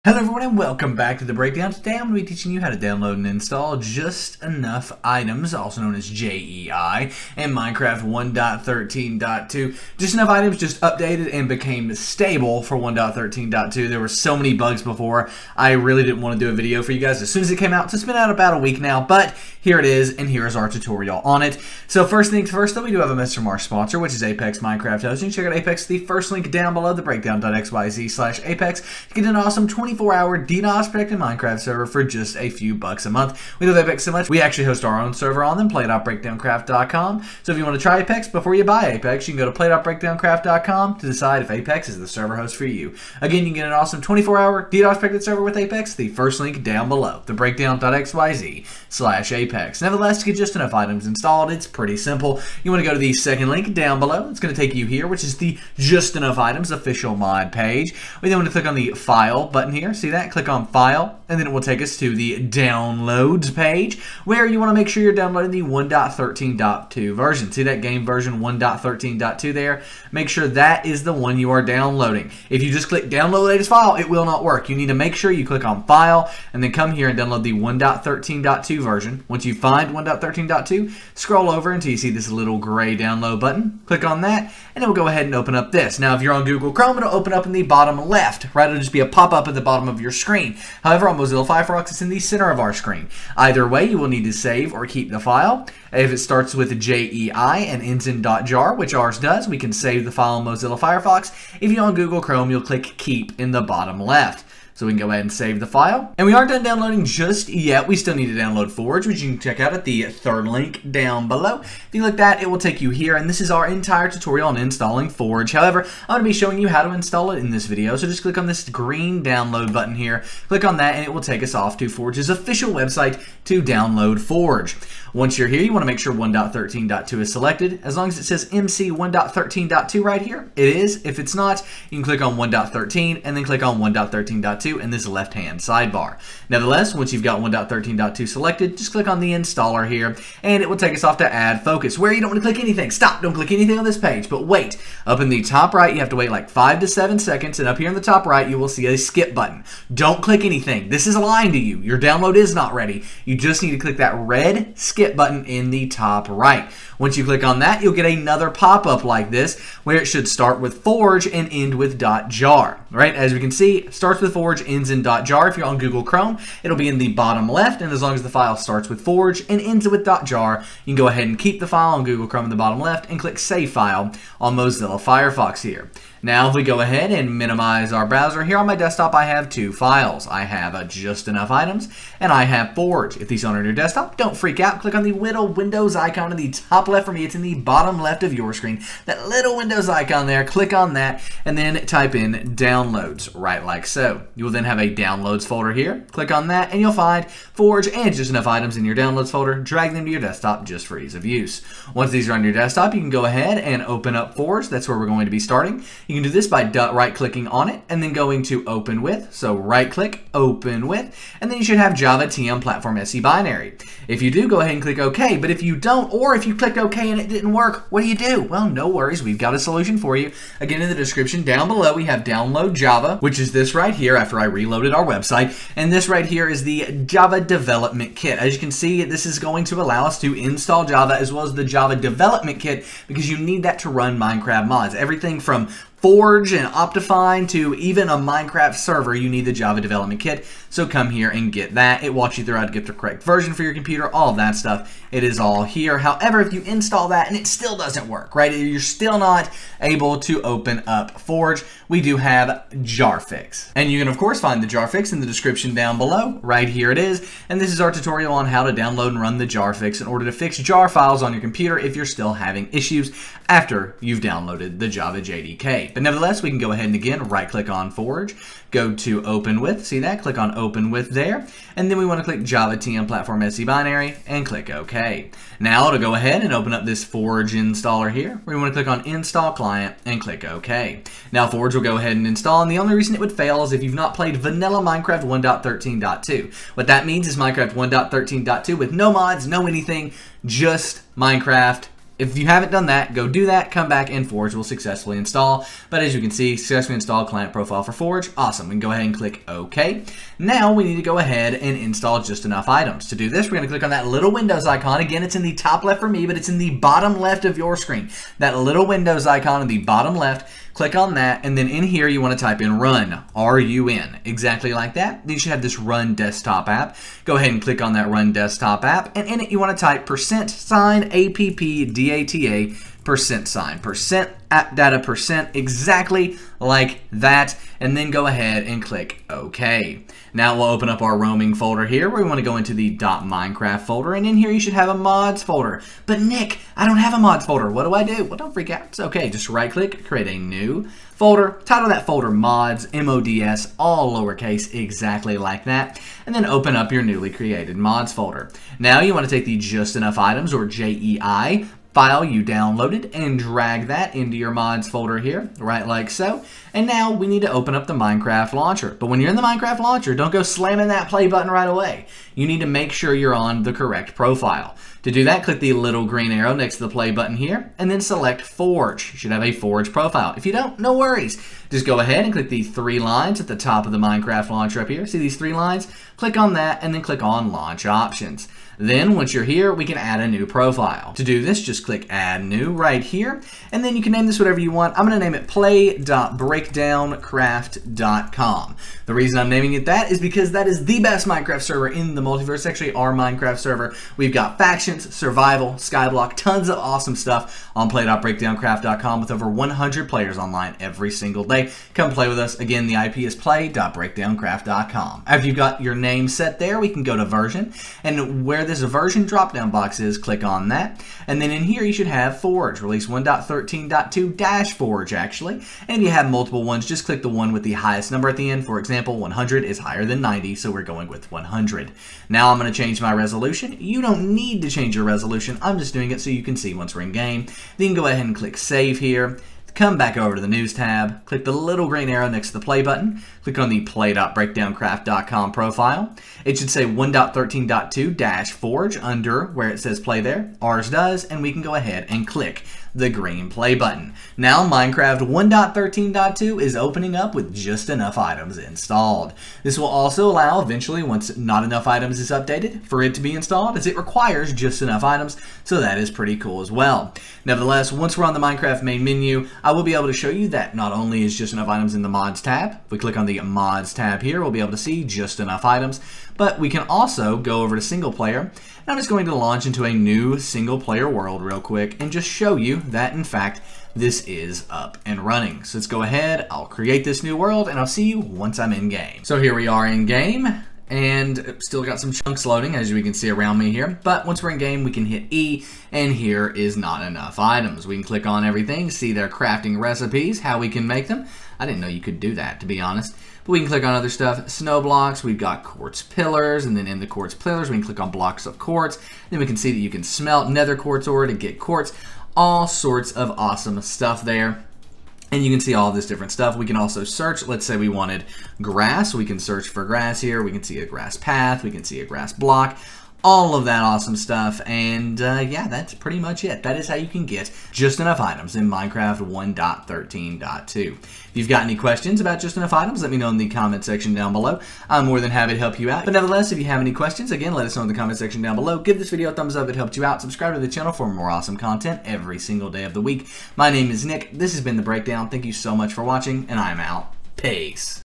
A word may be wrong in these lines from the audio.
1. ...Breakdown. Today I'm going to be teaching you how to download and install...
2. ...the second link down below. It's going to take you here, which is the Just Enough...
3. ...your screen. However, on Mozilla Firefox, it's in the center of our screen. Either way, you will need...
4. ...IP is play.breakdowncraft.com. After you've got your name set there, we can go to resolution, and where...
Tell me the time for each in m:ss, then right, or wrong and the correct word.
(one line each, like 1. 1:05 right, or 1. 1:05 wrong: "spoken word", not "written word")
1. 0:01 right
2. 0:52 right
3. 1:30 right
4. 6:42 wrong: "version", not "resolution".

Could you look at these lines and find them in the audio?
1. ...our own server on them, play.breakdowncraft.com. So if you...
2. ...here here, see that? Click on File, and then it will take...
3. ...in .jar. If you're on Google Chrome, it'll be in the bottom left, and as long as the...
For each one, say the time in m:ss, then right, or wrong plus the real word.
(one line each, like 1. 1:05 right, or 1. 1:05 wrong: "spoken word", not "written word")
1. 0:34 right
2. 0:59 right
3. 2:44 right.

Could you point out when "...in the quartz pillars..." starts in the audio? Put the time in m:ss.
8:16.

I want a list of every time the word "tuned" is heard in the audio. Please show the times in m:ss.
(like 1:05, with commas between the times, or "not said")
not said.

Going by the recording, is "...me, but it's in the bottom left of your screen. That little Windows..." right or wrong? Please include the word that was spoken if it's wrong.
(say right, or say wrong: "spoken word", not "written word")
right.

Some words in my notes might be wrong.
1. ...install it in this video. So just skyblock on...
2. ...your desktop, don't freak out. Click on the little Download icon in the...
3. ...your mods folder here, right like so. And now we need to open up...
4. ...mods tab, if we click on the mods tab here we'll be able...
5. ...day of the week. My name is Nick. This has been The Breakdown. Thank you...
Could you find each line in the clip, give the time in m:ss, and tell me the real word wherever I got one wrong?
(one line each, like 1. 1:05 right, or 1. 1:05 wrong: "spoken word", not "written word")
1. 1:56 wrong: "click", not "skyblock"
2. 3:03 wrong: "Windows", not "Download"
3. 5:54 right
4. 7:42 right
5. 8:52 right.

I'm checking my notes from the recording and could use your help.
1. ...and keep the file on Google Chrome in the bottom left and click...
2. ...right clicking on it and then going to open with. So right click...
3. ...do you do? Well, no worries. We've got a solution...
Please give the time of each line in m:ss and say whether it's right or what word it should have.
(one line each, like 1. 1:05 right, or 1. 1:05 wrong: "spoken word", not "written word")
1. 2:51 right
2. 3:26 right
3. 3:38 right.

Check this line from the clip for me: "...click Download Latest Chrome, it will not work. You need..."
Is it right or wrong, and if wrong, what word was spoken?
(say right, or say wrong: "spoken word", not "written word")
wrong: "File", not "Chrome".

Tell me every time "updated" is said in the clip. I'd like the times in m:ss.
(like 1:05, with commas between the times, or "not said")
0:10, 7:32.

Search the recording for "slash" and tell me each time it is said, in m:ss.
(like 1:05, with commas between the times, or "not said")
0:28, 0:48.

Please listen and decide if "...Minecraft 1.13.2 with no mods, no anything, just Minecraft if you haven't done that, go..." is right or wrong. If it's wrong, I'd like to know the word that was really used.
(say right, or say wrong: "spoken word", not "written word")
right.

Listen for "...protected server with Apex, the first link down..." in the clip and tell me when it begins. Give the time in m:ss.
0:44.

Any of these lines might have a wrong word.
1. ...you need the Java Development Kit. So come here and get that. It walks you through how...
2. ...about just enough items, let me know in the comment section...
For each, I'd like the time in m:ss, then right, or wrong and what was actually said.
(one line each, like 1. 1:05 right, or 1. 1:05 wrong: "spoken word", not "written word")
1. 3:59 right
2. 8:42 right.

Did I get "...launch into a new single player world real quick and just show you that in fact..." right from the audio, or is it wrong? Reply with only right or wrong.
right.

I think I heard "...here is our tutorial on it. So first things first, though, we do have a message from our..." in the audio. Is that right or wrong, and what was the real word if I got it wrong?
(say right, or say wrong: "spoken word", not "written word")
right.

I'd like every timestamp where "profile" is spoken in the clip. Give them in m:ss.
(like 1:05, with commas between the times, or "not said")
4:57, 6:04, 6:09, 6:20, 7:15.